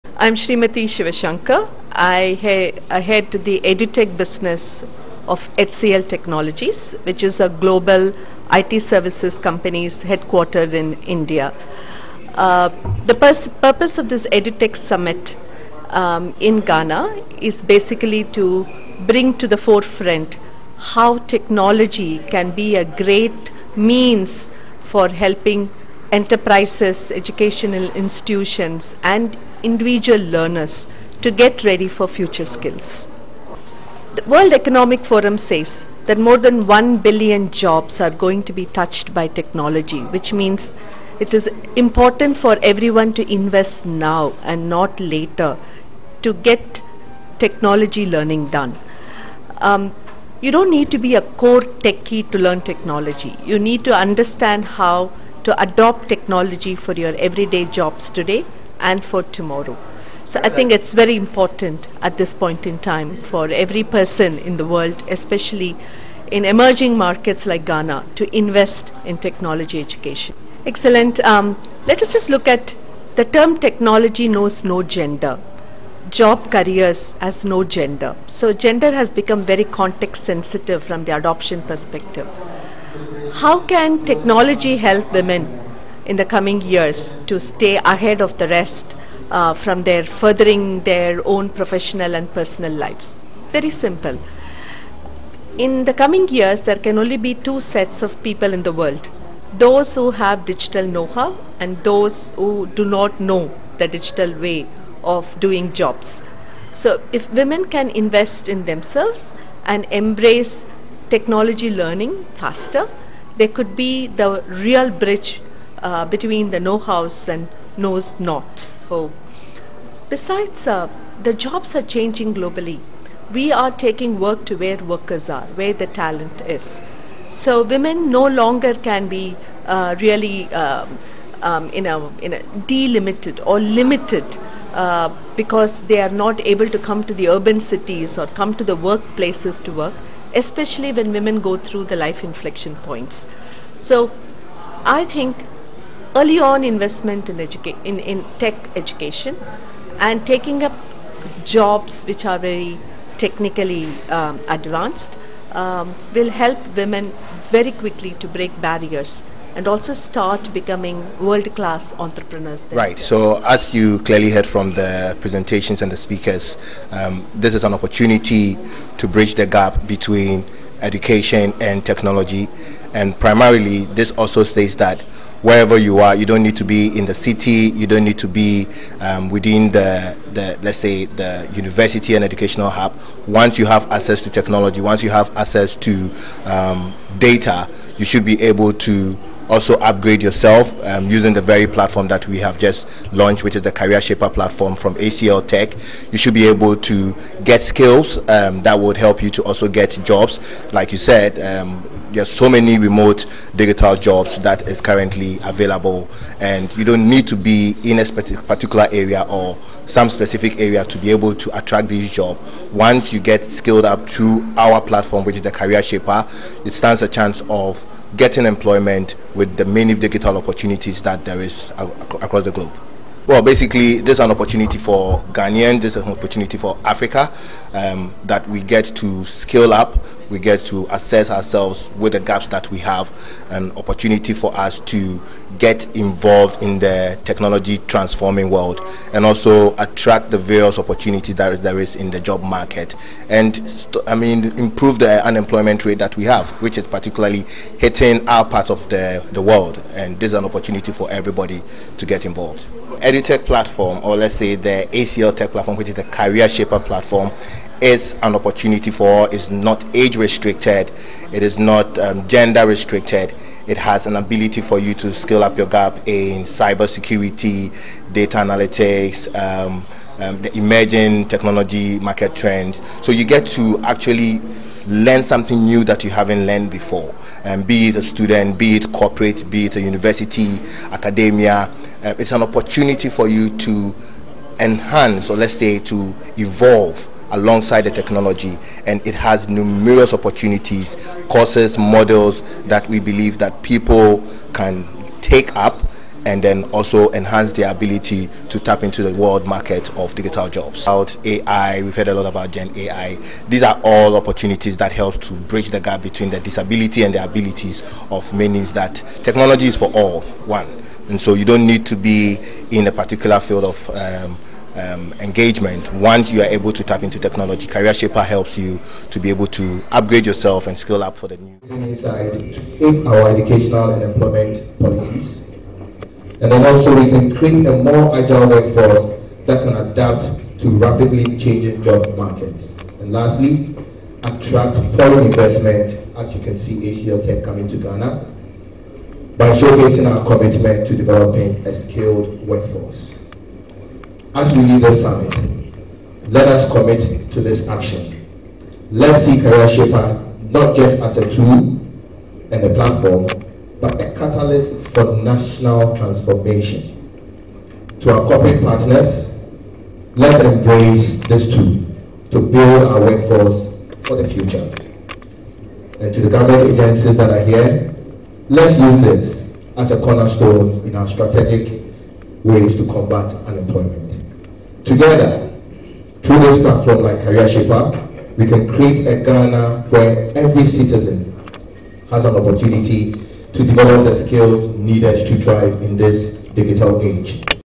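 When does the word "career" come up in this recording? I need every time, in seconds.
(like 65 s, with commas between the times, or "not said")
76 s, 193 s, 215 s, 256 s, 317 s, 349 s, 377 s.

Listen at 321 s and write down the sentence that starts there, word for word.
Inside our educational and employment policies.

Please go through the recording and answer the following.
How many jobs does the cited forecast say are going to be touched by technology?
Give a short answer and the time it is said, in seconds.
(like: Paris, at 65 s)
More than 1 billion, at 36 s.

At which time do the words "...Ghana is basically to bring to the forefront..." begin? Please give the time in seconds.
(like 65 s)
16 s.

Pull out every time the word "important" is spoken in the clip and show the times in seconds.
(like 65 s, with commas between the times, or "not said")
41 s, 61 s.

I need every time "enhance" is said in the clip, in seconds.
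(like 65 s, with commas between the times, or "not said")
284 s, 297 s.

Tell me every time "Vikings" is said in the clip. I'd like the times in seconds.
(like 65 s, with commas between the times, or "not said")
not said.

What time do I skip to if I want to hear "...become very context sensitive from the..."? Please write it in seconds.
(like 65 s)
79 s.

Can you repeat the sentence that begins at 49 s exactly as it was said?
Um, you don't need to be a core techie to learn technology.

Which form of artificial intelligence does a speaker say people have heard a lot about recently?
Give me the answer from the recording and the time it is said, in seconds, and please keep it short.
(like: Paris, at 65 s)
Gen AI, at 302 s.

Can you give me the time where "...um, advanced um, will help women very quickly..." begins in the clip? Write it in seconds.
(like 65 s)
154 s.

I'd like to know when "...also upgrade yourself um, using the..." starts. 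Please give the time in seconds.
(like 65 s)
189 s.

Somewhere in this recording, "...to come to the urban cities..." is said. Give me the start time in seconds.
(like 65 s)
136 s.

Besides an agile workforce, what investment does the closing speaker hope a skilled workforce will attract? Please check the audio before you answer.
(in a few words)
Foreign investment.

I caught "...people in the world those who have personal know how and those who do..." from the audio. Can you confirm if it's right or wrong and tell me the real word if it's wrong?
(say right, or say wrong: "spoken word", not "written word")
wrong: "digital", not "personal".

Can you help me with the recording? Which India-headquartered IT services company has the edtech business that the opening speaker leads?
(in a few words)
HCL Technologies.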